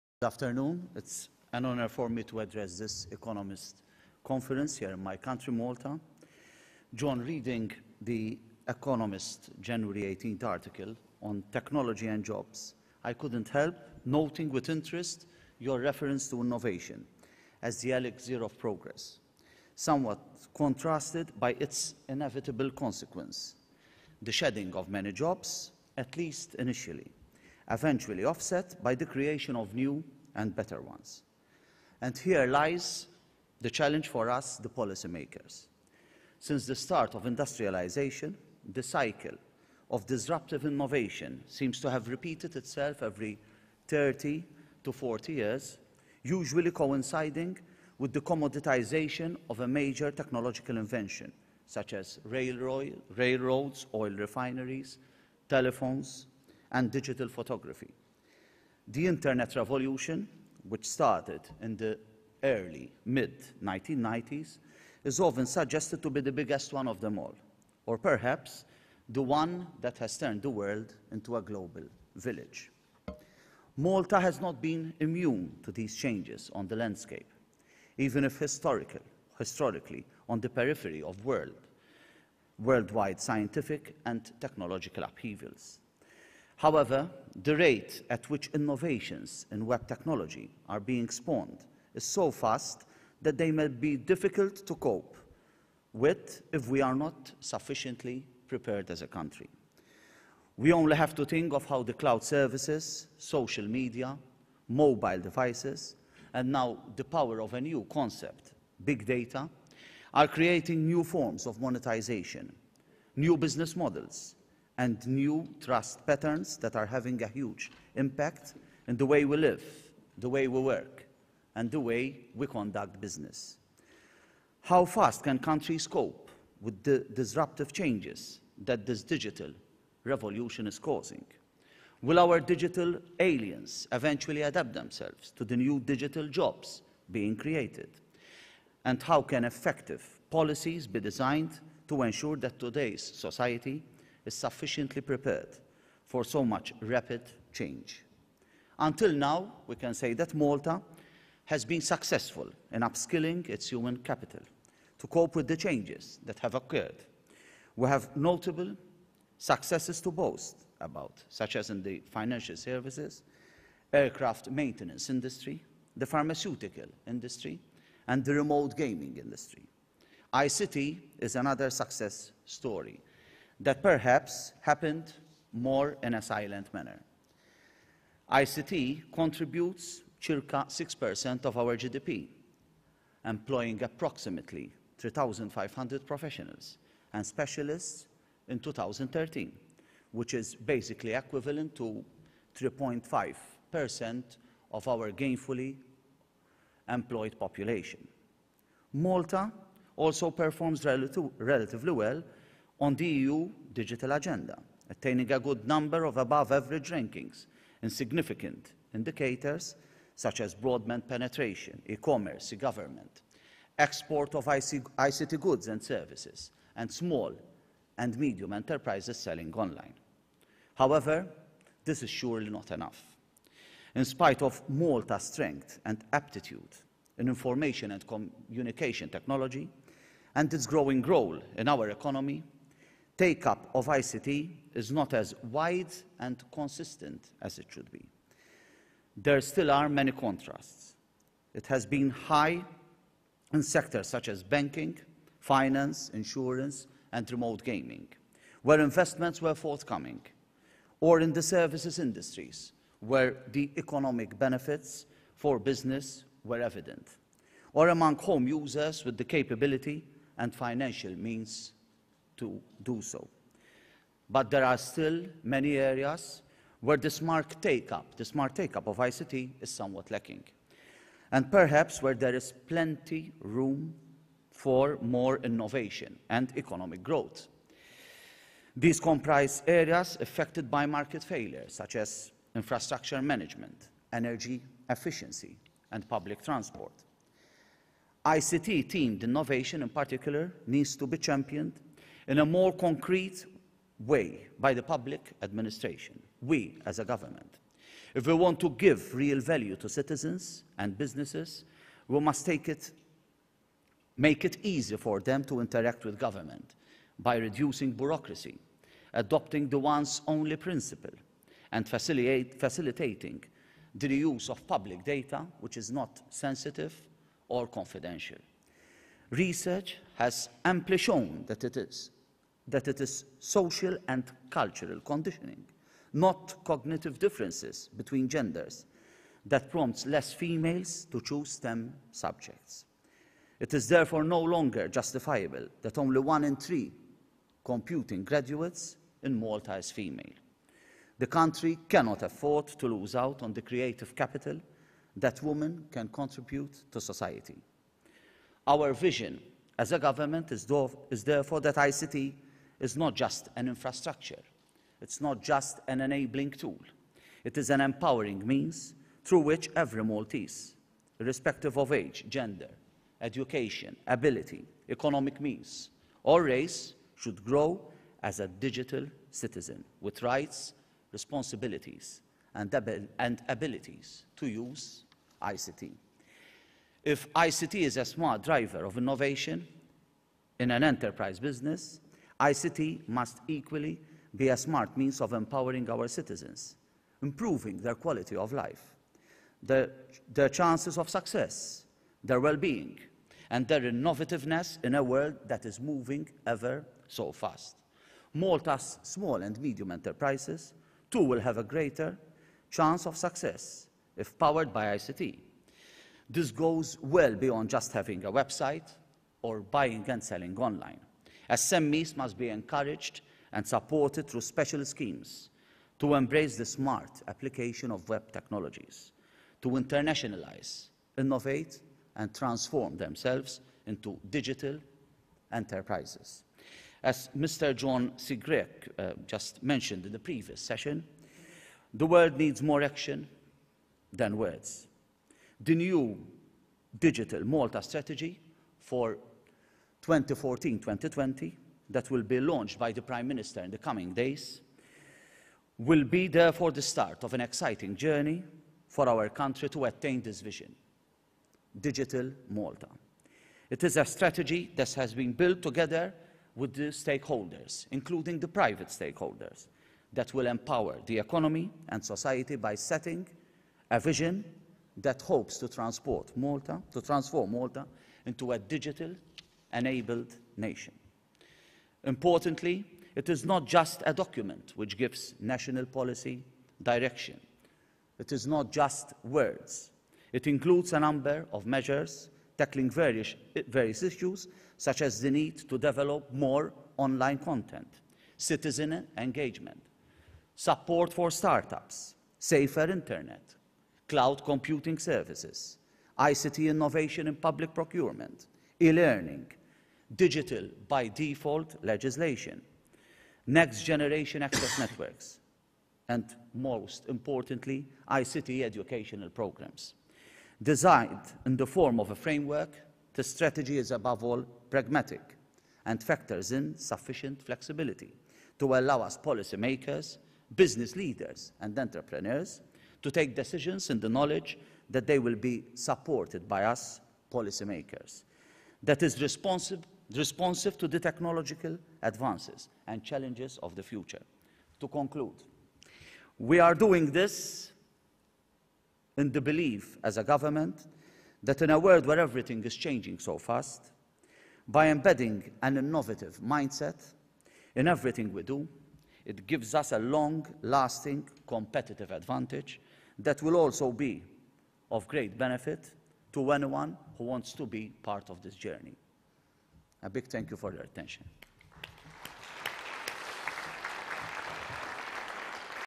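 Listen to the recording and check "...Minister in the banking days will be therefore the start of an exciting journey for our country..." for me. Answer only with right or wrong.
wrong.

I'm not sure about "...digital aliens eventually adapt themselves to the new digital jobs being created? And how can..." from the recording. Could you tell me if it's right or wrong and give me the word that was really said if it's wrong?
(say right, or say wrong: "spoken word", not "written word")
right.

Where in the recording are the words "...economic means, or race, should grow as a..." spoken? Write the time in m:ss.
6:04.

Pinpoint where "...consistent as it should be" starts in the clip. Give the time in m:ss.
3:56.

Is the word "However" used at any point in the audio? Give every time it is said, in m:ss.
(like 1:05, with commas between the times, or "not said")
1:26, 3:40.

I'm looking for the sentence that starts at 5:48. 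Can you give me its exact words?
Our vision as a government is, therefore that ICT is not just an infrastructure.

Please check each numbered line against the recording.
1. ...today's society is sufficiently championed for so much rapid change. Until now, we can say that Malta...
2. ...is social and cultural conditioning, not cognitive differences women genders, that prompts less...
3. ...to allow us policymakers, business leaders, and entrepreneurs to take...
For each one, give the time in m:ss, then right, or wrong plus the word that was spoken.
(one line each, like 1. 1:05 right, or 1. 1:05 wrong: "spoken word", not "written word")
1. 2:22 wrong: "prepared", not "championed"
2. 5:23 wrong: "between", not "women"
3. 8:38 right.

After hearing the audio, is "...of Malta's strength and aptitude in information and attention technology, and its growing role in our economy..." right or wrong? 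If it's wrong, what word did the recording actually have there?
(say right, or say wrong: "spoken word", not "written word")
wrong: "communication", not "attention".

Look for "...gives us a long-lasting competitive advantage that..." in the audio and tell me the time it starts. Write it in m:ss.
9:09.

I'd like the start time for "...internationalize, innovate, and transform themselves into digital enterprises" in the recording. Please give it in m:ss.
6:59.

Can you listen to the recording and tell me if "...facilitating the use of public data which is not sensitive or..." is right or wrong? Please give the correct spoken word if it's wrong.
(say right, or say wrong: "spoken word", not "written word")
right.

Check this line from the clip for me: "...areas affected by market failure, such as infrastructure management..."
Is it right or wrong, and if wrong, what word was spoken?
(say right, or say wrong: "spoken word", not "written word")
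right.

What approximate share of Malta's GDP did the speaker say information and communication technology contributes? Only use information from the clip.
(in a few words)
6%.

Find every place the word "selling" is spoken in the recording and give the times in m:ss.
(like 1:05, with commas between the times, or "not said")
3:39, 6:50.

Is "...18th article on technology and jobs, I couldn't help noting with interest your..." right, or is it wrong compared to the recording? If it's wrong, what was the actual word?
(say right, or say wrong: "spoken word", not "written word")
right.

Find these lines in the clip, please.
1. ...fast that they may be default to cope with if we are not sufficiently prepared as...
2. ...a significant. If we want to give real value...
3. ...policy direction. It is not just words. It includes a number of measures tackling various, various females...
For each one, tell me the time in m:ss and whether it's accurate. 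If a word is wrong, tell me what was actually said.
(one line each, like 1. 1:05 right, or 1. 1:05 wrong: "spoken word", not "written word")
1. 1:32 wrong: "difficult", not "default"
2. 4:56 wrong: "government", not "significant"
3. 7:55 wrong: "issues", not "females".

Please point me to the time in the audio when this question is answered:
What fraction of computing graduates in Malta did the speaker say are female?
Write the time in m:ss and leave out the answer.
5:36.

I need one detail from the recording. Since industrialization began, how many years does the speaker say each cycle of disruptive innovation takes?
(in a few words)
30 to 40 years.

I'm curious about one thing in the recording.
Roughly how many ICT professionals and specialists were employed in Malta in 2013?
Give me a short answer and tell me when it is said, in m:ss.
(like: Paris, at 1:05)
3,500, at 3:03.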